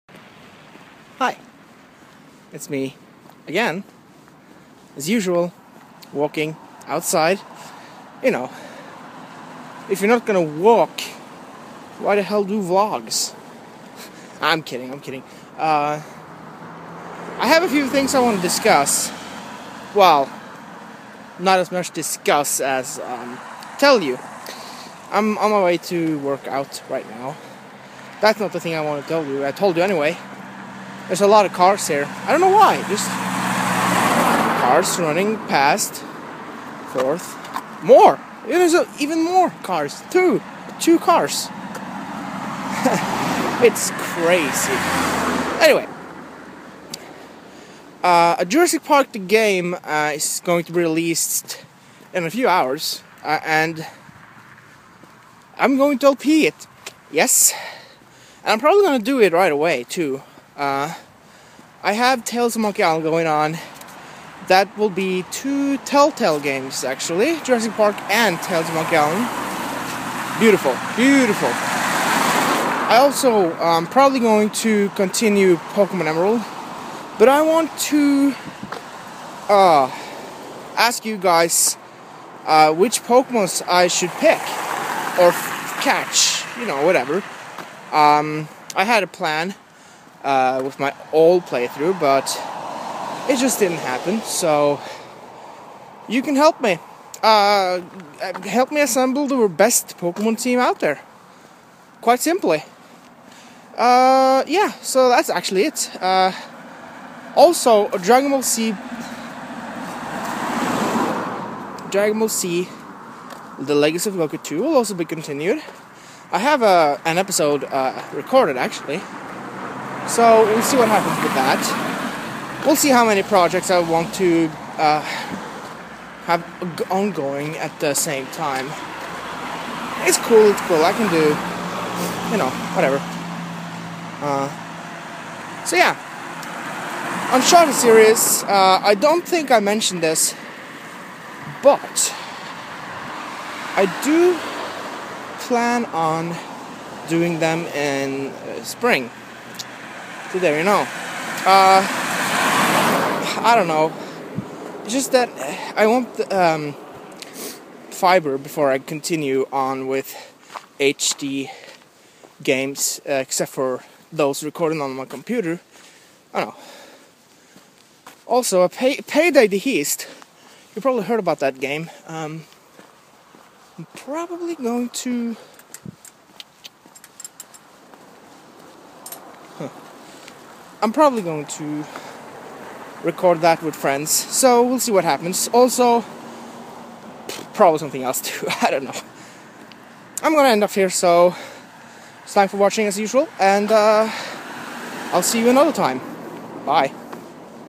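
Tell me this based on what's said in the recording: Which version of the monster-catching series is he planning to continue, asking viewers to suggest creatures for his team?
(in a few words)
Pokemon Emerald.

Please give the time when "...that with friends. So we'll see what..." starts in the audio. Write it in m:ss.
3:03.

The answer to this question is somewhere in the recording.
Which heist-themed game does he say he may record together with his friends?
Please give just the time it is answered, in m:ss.
2:49.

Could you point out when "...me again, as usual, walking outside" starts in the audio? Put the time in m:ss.
0:02.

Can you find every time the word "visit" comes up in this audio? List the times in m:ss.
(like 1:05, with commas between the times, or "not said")
not said.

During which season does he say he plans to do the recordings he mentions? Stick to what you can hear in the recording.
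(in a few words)
Spring.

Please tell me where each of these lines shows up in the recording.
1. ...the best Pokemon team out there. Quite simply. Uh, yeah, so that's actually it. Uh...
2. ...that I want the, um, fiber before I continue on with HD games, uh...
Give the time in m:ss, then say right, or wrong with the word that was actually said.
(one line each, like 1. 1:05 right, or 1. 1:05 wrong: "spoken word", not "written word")
1. 1:39 right
2. 2:35 right.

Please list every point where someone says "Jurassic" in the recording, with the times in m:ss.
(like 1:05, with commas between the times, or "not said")
0:48, 1:07.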